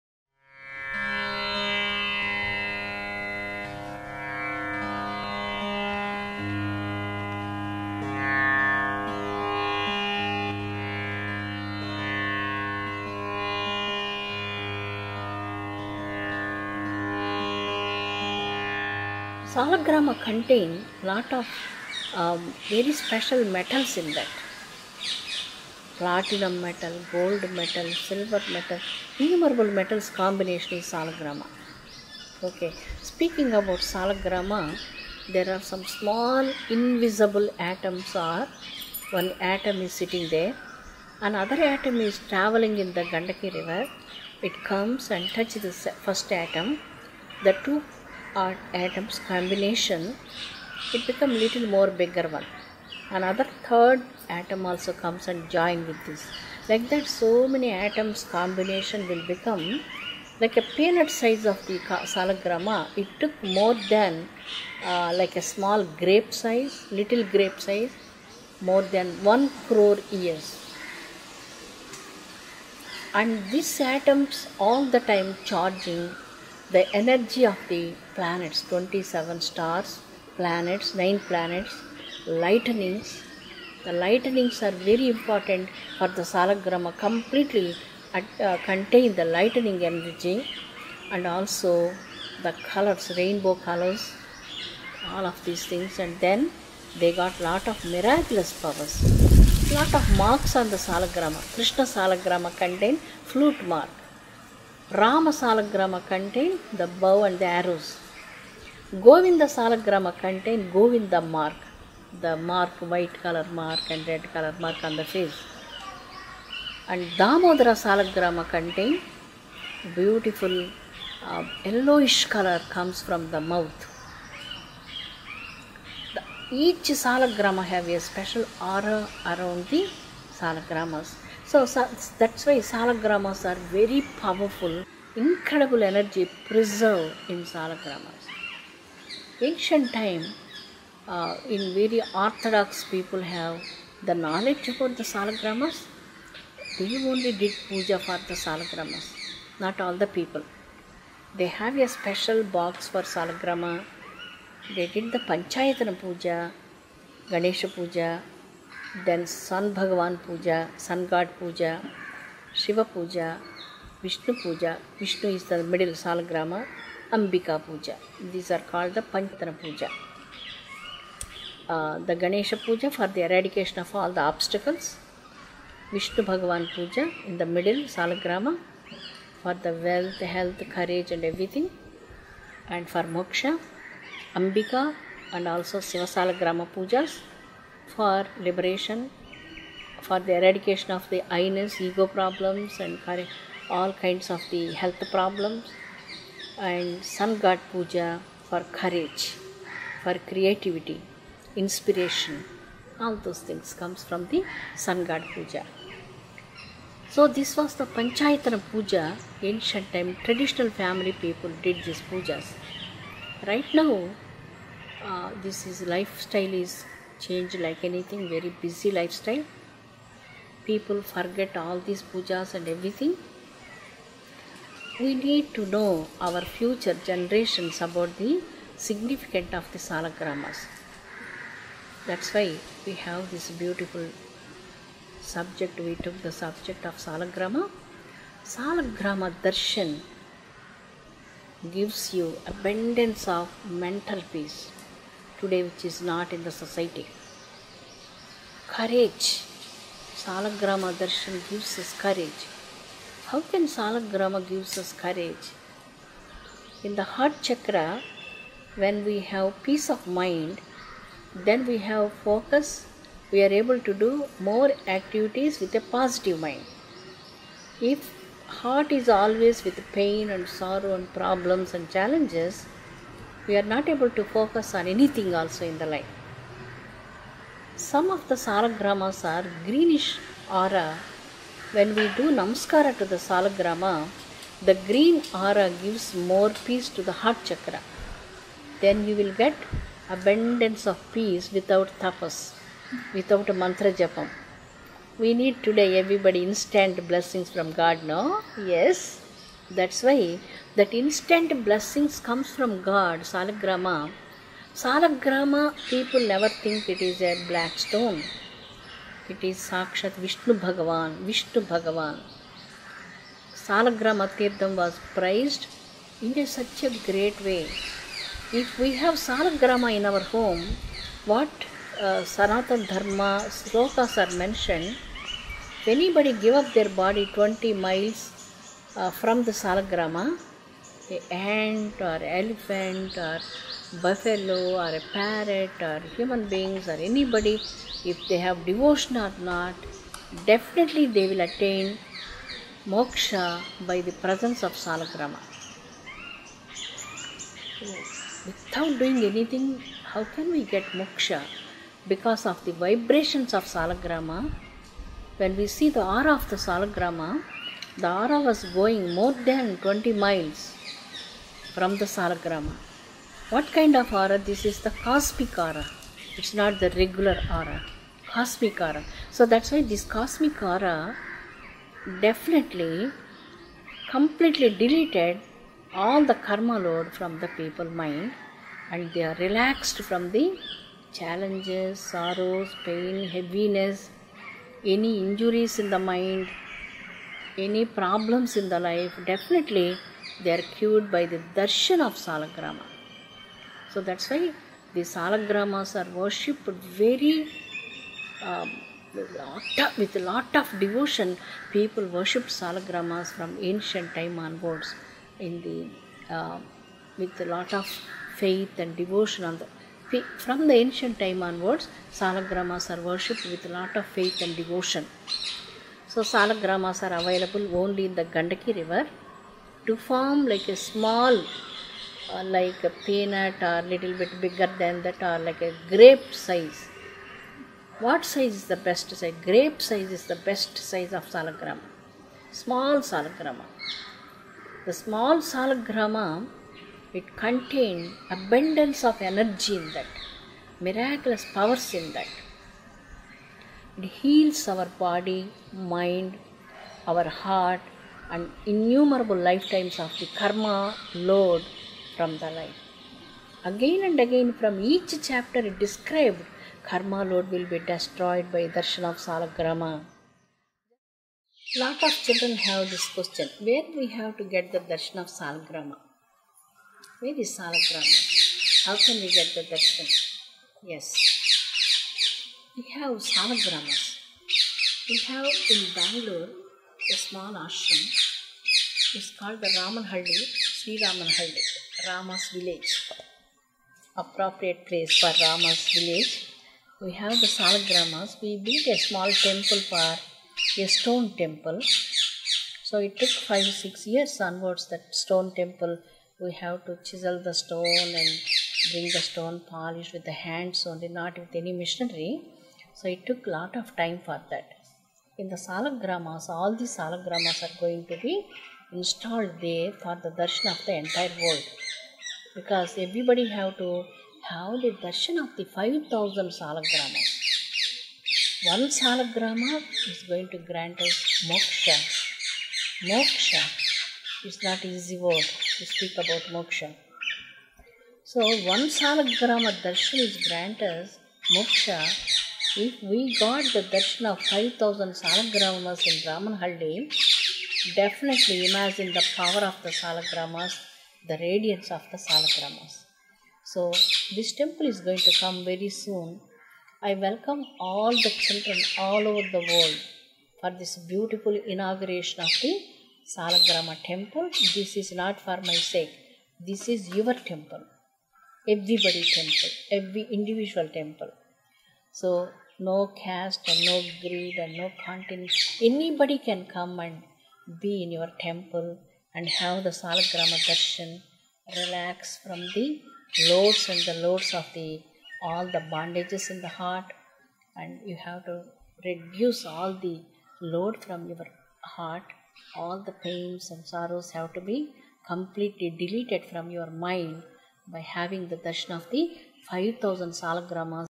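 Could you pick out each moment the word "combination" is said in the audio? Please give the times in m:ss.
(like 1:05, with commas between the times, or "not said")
0:30, 0:49, 0:58.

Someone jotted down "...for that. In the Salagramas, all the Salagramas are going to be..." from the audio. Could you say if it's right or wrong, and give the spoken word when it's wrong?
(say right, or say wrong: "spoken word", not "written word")
right.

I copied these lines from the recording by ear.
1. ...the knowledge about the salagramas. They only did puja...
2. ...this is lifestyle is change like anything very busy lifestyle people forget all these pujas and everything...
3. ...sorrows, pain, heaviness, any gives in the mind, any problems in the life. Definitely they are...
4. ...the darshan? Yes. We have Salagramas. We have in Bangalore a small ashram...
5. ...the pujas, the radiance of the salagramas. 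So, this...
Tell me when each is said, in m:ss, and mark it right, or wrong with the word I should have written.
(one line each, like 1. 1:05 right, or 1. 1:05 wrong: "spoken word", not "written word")
1. 2:24 right
2. 3:35 right
3. 6:21 wrong: "injuries", not "gives"
4. 7:49 right
5. 8:59 wrong: "salagramas", not "pujas".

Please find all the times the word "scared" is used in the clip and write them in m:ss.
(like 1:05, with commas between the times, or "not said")
not said.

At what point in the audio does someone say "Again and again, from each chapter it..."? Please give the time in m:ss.
7:33.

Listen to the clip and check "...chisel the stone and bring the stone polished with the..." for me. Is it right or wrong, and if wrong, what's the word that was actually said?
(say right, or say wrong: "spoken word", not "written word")
right.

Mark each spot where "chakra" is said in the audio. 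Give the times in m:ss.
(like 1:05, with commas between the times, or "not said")
4:17, 4:47.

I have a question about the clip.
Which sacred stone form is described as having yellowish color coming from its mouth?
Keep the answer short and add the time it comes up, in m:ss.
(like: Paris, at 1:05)
Damodara, at 1:57.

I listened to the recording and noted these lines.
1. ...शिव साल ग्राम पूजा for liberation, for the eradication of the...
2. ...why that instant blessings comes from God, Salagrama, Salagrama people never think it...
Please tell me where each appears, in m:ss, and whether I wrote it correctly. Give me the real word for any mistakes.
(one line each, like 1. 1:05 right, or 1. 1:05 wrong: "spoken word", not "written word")
1. 3:05 right
2. 5:00 right.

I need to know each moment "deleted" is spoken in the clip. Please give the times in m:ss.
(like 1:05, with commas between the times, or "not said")
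6:14, 9:45.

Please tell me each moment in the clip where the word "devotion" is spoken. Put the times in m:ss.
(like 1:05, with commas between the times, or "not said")
5:38, 6:40, 6:49, 6:54.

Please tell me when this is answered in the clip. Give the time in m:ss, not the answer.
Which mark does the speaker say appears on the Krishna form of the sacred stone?
1:43.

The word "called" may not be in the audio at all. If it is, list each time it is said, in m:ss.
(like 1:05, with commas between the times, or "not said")
7:59.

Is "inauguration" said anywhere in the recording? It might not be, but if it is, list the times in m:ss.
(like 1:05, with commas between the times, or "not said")
9:11.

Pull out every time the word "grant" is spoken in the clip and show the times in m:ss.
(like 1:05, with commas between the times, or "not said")
8:40, 8:50.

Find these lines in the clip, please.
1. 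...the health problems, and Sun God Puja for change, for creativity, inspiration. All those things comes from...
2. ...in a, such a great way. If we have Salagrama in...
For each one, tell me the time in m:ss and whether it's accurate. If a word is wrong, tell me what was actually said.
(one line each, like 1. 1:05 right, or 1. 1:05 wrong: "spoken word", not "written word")
1. 3:14 wrong: "courage", not "change"
2. 5:16 right.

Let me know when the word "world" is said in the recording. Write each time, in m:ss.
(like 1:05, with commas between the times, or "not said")
8:31, 9:09.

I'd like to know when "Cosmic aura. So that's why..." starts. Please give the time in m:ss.
6:08.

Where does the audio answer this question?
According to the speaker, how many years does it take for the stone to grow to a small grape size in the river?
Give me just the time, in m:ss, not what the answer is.
1:08.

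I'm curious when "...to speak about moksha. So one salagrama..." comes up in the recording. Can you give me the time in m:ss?
8:45.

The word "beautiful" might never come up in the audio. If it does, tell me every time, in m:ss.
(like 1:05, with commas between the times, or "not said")
1:59, 3:53, 9:10.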